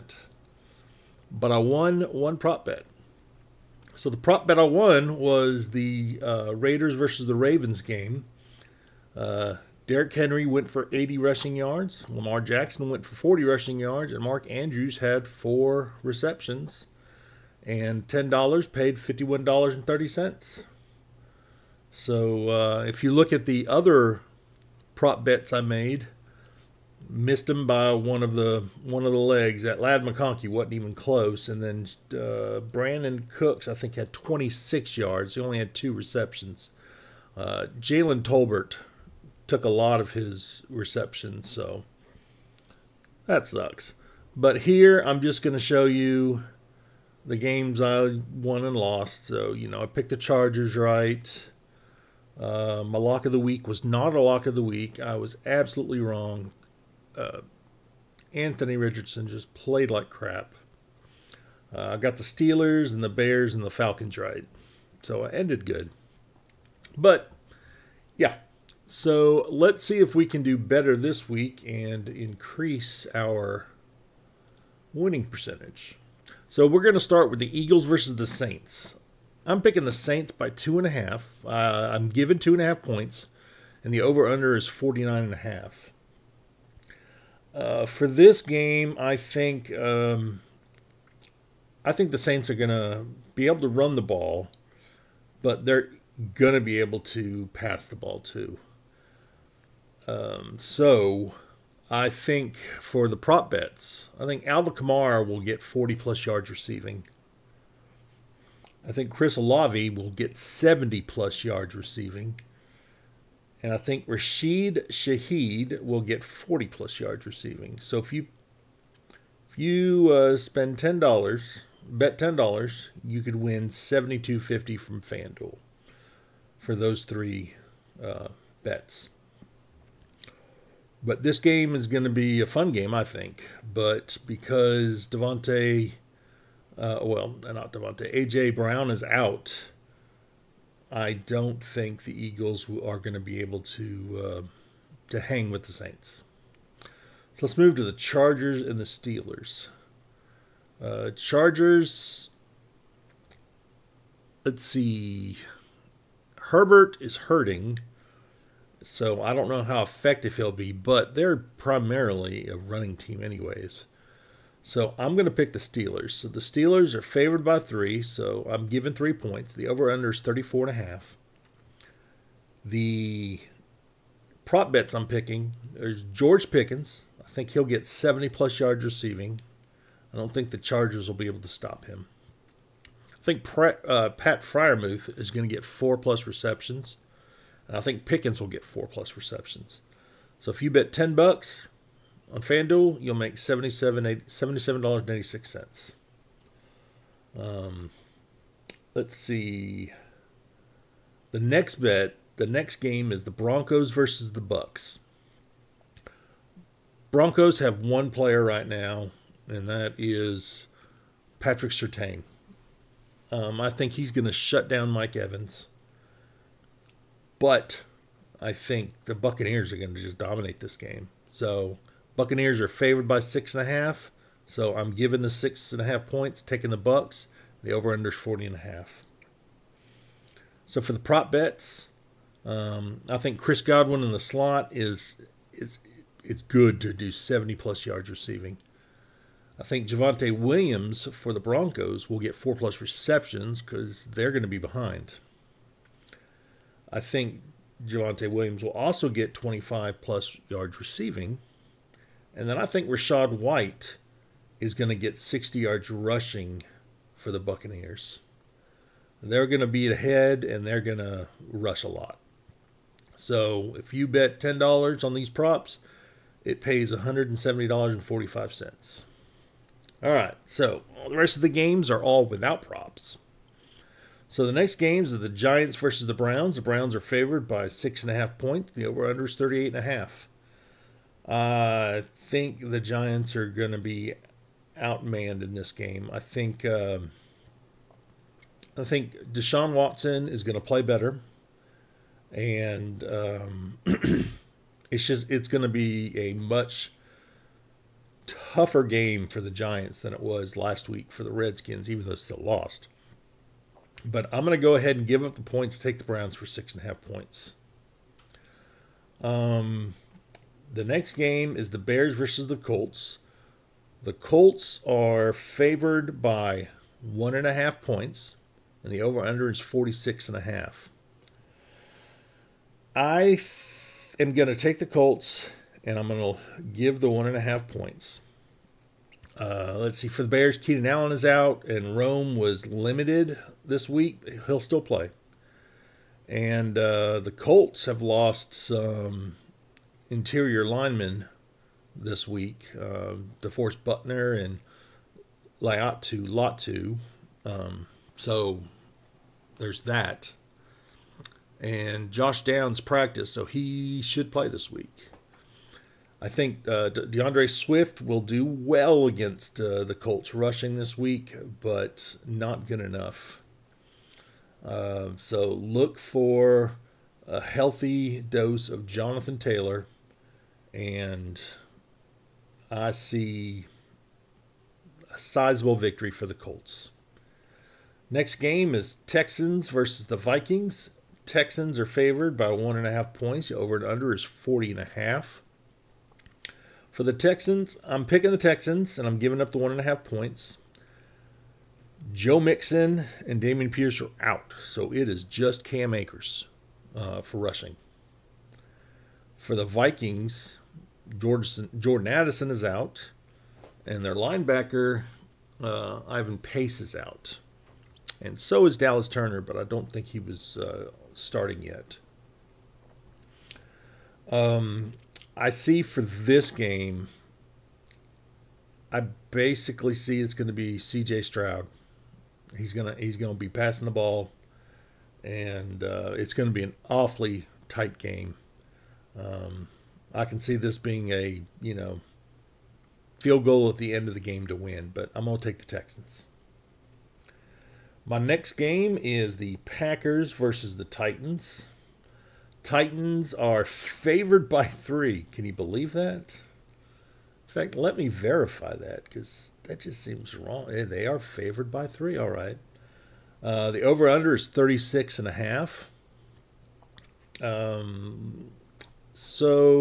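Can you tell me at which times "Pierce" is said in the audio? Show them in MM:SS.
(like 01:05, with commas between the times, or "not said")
06:33.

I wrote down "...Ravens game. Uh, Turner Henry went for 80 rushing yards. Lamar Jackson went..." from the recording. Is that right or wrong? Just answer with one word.
wrong.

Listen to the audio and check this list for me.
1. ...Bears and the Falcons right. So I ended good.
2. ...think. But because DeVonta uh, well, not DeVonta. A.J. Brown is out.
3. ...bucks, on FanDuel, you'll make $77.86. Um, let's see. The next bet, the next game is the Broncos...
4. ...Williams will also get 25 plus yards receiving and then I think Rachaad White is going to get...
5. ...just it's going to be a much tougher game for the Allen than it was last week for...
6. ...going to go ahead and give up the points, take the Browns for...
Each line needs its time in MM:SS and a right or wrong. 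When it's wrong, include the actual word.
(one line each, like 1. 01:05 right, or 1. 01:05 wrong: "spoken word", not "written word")
1. 01:03 right
2. 02:13 right
3. 03:11 right
4. 04:08 right
5. 04:55 wrong: "Giants", not "Allen"
6. 05:04 right.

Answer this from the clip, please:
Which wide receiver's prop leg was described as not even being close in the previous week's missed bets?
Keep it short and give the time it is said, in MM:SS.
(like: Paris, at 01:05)
Ladd McConkey, at 00:29.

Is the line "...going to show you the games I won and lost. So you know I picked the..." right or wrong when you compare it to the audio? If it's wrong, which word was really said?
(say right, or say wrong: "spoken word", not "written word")
right.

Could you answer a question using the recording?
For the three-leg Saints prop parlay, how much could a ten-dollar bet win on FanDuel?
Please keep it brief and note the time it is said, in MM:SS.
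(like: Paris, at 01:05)
$72.50, at 02:03.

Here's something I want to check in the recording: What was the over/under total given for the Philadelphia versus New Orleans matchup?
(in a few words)
49.5.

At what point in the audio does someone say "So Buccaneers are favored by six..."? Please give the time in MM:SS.
03:41.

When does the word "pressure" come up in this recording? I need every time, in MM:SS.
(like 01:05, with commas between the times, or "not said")
not said.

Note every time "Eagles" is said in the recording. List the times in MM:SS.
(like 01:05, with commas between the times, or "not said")
01:17, 02:22.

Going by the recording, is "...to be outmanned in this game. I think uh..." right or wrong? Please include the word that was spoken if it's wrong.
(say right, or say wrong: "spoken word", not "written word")
right.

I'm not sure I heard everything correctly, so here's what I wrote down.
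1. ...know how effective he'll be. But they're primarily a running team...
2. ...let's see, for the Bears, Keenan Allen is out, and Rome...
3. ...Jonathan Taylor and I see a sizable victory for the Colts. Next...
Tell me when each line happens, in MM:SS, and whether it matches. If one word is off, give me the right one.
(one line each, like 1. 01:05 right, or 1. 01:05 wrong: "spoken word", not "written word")
1. 02:39 right
2. 05:29 right
3. 06:08 right.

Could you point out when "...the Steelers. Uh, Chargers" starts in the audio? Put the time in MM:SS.
02:28.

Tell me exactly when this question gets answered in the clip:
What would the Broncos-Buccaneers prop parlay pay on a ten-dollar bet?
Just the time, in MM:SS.
04:26.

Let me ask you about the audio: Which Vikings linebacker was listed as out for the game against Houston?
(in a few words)
Ivan Pace.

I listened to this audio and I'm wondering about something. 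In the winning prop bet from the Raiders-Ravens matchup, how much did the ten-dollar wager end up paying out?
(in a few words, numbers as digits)
$51.30.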